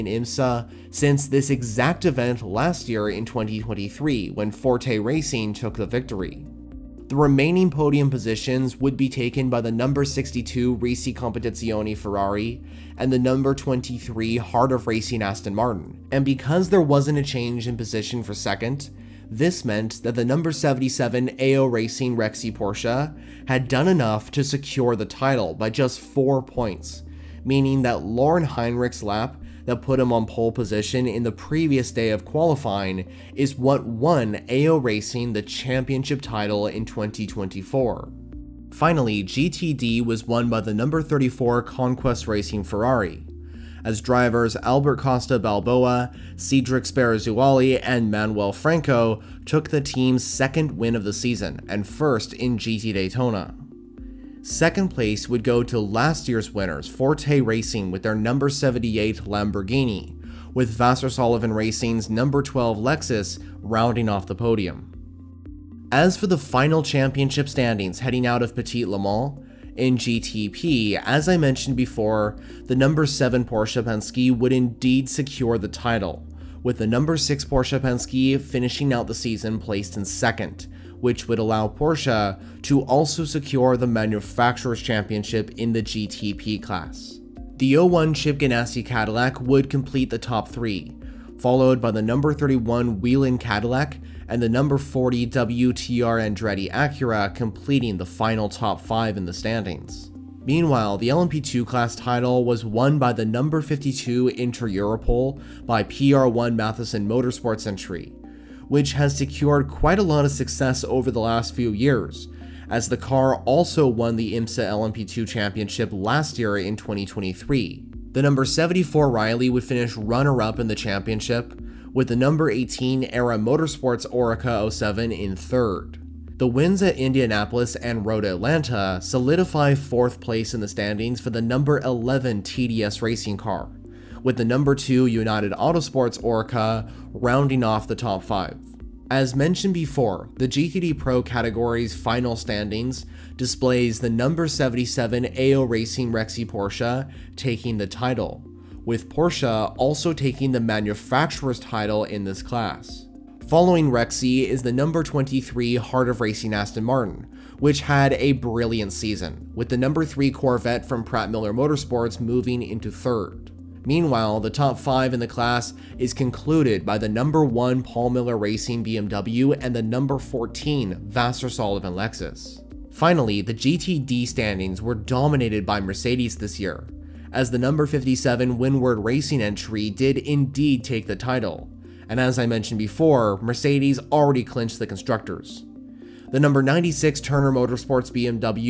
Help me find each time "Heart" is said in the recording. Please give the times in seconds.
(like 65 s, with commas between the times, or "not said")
14 s, 155 s.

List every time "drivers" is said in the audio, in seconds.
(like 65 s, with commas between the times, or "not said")
44 s.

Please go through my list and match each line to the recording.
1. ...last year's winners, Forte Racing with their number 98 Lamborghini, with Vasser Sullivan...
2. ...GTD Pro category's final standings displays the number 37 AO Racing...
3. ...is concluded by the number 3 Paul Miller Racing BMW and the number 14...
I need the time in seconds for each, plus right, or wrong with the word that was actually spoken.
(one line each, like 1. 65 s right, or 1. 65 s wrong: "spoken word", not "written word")
1. 55 s wrong: "78", not "98"
2. 140 s wrong: "77", not "37"
3. 165 s wrong: "1", not "3".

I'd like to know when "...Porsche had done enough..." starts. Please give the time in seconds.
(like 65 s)
22 s.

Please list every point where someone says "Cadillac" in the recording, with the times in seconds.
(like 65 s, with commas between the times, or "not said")
88 s, 93 s.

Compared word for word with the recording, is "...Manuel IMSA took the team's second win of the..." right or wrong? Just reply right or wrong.
wrong.